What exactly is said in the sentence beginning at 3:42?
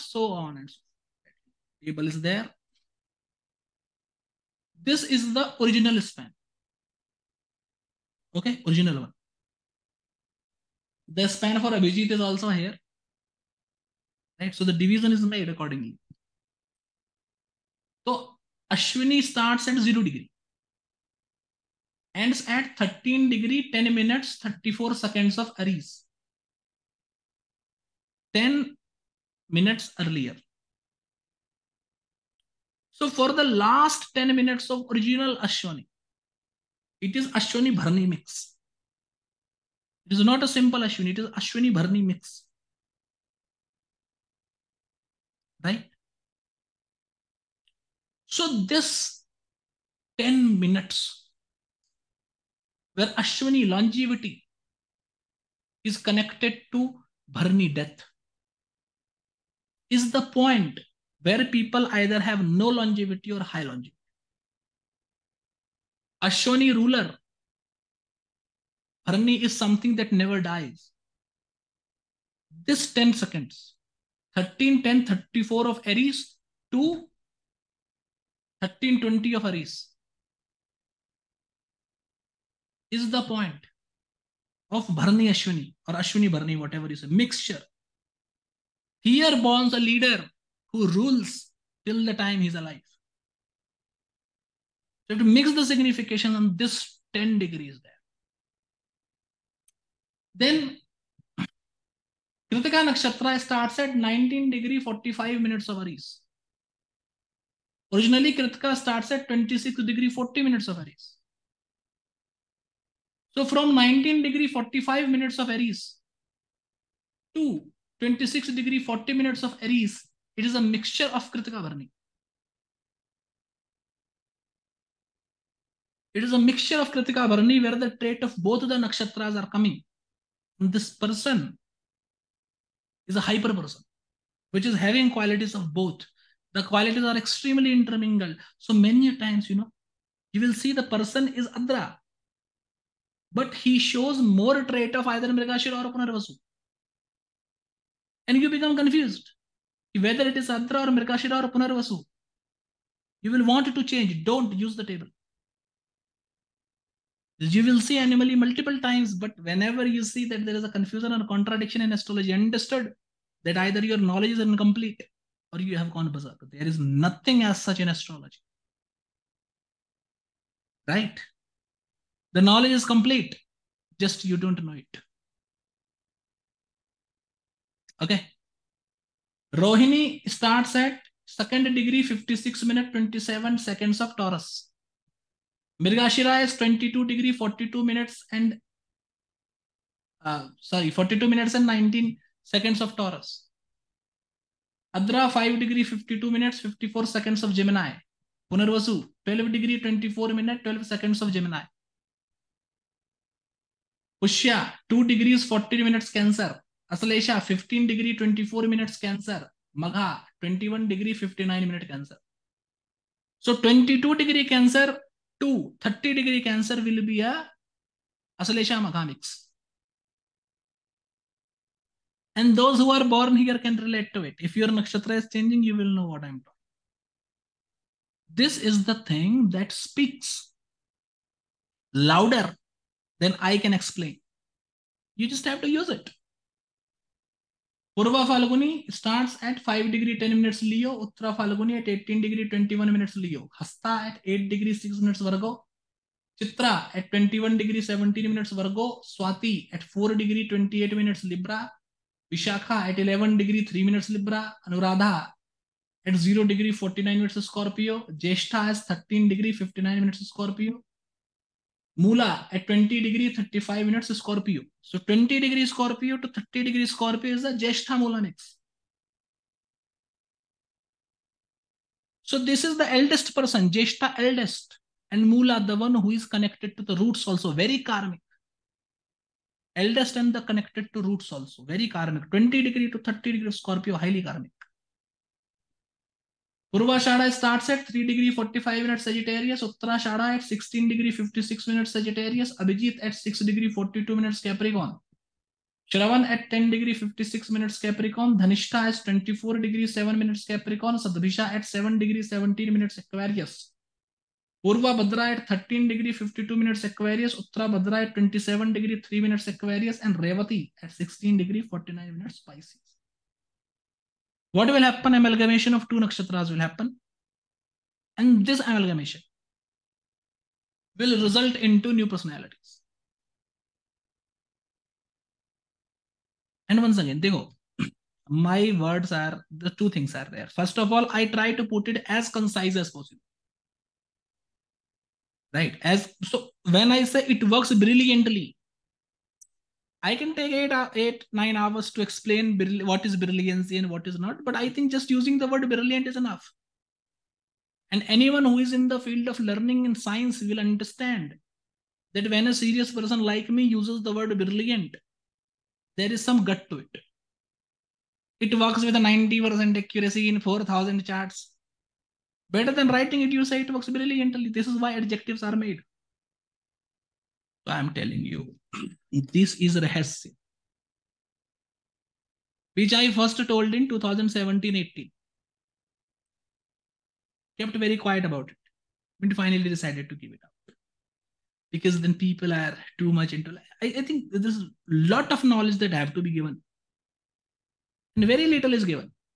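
And those who are born here can relate to it.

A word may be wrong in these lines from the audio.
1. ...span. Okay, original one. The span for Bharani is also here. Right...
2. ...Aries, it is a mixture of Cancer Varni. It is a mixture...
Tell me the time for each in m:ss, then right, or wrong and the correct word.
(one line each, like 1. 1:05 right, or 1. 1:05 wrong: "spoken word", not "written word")
1. 0:06 wrong: "Abhijit", not "Bharani"
2. 1:59 wrong: "Kritika", not "Cancer".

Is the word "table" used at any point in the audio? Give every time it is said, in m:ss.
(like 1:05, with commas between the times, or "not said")
0:01, 2:34.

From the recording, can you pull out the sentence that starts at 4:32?
So this is the eldest person, Jeshta eldest, and Mula the one who is connected to the roots also, very karmic.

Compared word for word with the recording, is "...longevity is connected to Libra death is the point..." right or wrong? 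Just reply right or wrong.
wrong.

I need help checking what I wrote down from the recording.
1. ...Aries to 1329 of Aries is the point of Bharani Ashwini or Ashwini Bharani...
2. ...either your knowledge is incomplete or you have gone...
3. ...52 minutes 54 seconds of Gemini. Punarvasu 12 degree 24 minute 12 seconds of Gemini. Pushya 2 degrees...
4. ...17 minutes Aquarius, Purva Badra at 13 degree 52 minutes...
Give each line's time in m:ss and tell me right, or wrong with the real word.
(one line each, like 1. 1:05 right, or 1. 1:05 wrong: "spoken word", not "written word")
1. 1:15 wrong: "1320", not "1329"
2. 2:43 right
3. 3:15 right
4. 5:02 right.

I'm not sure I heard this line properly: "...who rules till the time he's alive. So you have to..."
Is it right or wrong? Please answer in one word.
right.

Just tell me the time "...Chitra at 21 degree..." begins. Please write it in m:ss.
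4:06.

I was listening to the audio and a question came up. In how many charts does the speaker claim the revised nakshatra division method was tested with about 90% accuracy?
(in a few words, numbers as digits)
4,000.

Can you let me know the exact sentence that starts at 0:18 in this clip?
So Ashwini starts at 0 degree.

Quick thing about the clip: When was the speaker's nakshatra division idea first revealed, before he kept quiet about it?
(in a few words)
2017-18.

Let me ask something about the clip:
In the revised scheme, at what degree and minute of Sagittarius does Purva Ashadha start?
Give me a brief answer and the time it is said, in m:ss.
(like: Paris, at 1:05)
3 degrees 45 minutes, at 4:47.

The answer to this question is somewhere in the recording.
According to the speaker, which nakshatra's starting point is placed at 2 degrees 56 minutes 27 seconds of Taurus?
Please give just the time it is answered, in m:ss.
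2:59.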